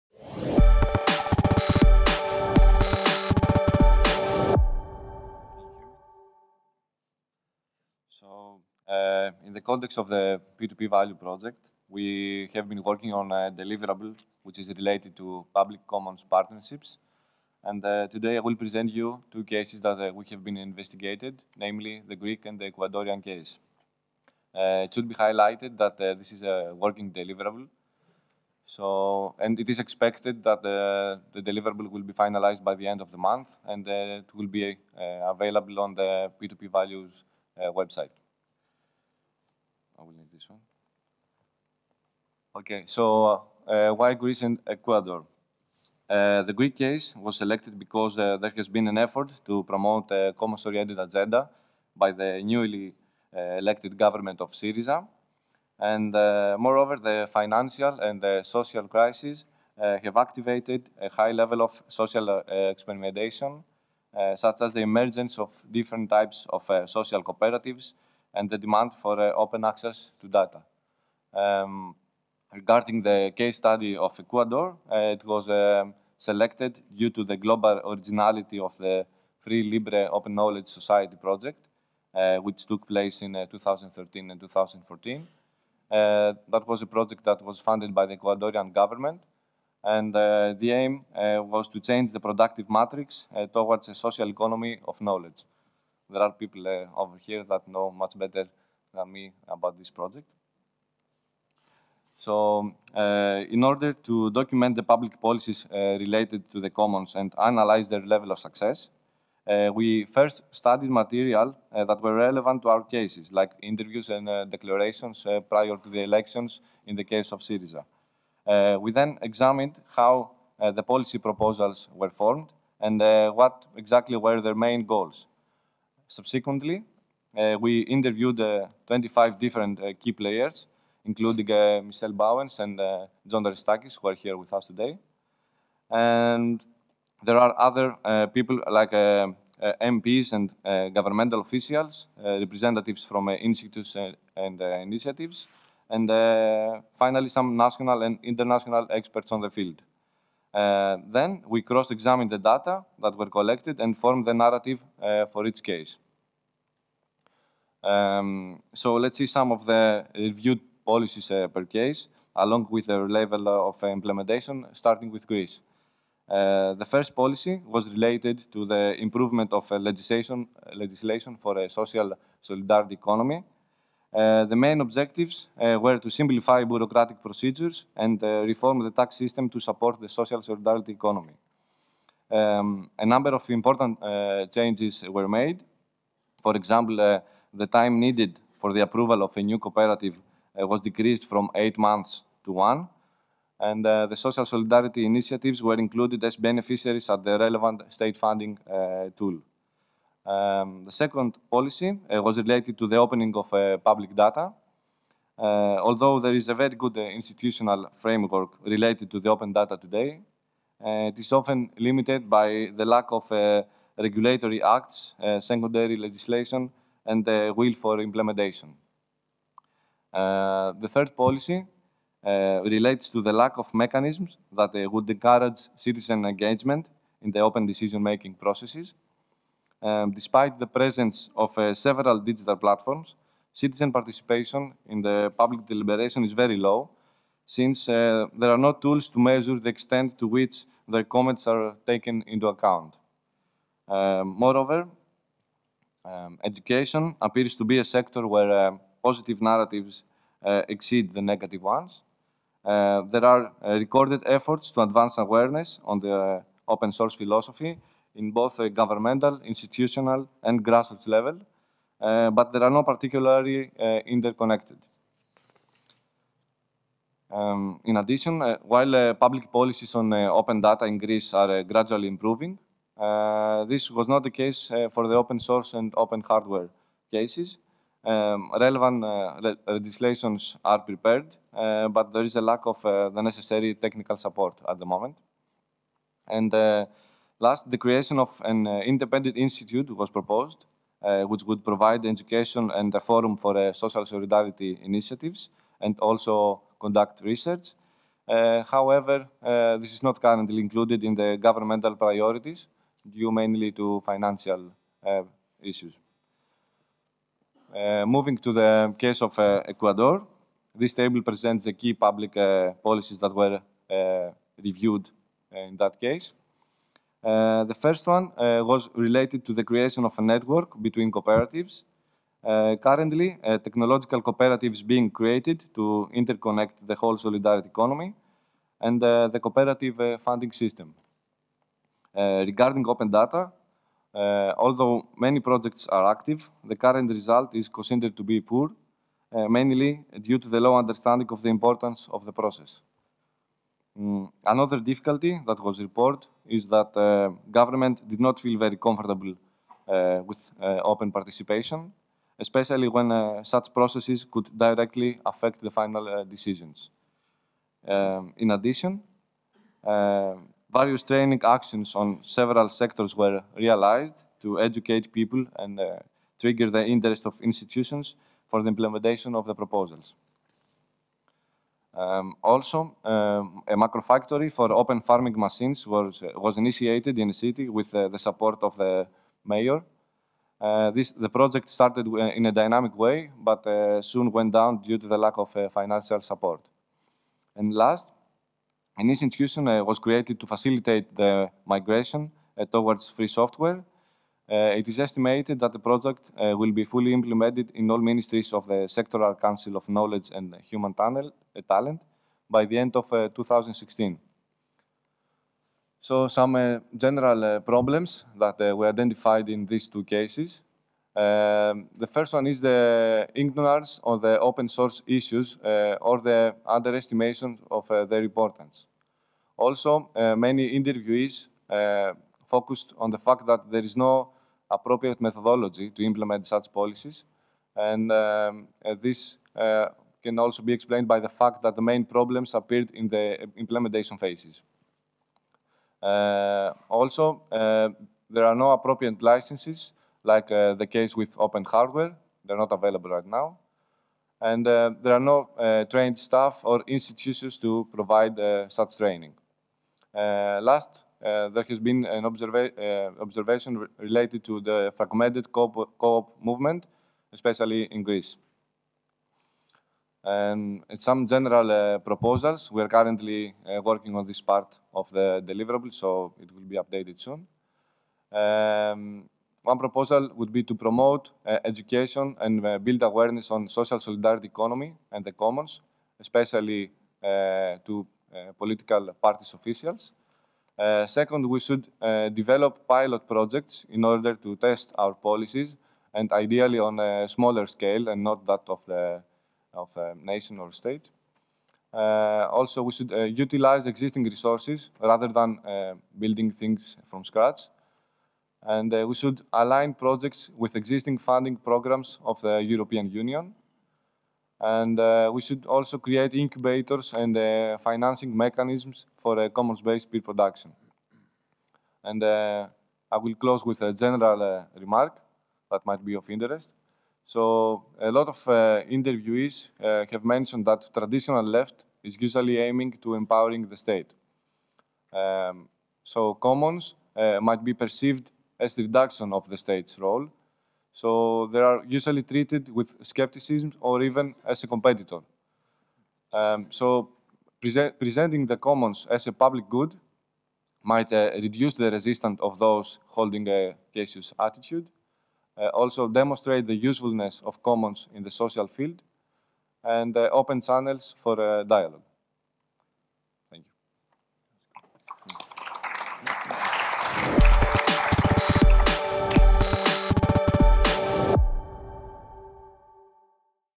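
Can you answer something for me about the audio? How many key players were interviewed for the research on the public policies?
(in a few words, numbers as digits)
25.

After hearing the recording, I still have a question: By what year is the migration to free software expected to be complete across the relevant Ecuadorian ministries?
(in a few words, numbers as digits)
2016.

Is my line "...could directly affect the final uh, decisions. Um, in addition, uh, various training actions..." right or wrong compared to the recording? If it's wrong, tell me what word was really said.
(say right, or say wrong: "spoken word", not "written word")
right.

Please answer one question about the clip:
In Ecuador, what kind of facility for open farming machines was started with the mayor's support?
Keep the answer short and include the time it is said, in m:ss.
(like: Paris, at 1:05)
macro factory, at 6:13.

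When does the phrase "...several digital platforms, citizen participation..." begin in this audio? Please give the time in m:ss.
3:51.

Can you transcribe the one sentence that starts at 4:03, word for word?
Um, moreover, um, education appears to be a sector where uh, positive narratives uh, exceed the negative ones.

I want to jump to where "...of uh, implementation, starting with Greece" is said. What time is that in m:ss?
2:43.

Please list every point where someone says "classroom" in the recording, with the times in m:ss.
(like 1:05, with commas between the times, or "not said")
not said.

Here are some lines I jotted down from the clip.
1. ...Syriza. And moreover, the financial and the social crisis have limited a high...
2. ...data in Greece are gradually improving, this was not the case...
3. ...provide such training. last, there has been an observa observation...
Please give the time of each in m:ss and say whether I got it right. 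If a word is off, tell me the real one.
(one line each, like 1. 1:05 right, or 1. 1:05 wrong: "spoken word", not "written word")
1. 0:54 wrong: "activated", not "limited"
2. 4:30 right
3. 7:27 right.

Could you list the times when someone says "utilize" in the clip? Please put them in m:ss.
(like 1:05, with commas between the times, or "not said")
8:13.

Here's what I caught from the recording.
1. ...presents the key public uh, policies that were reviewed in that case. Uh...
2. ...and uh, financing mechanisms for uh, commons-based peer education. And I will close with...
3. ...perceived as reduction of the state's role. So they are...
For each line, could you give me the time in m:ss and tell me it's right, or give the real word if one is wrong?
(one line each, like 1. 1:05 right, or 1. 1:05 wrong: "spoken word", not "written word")
1. 5:11 right
2. 8:27 wrong: "production", not "education"
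3. 8:47 right.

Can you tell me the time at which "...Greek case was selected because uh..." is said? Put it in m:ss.
0:46.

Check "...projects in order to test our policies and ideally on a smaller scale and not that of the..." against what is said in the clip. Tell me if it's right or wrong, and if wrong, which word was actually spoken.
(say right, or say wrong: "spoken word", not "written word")
right.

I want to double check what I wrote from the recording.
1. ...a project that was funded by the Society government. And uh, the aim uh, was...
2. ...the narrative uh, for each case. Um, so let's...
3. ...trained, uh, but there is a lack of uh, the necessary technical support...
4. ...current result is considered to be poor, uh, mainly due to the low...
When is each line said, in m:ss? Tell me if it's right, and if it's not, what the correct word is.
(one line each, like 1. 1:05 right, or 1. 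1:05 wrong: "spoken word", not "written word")
1. 1:26 wrong: "Ecuadorian", not "Society"
2. 2:34 right
3. 4:40 wrong: "prepared", not "trained"
4. 5:36 right.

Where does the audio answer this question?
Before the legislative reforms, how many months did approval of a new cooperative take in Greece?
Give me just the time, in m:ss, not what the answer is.
3:11.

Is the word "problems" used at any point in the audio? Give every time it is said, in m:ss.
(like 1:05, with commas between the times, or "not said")
6:47, 7:12.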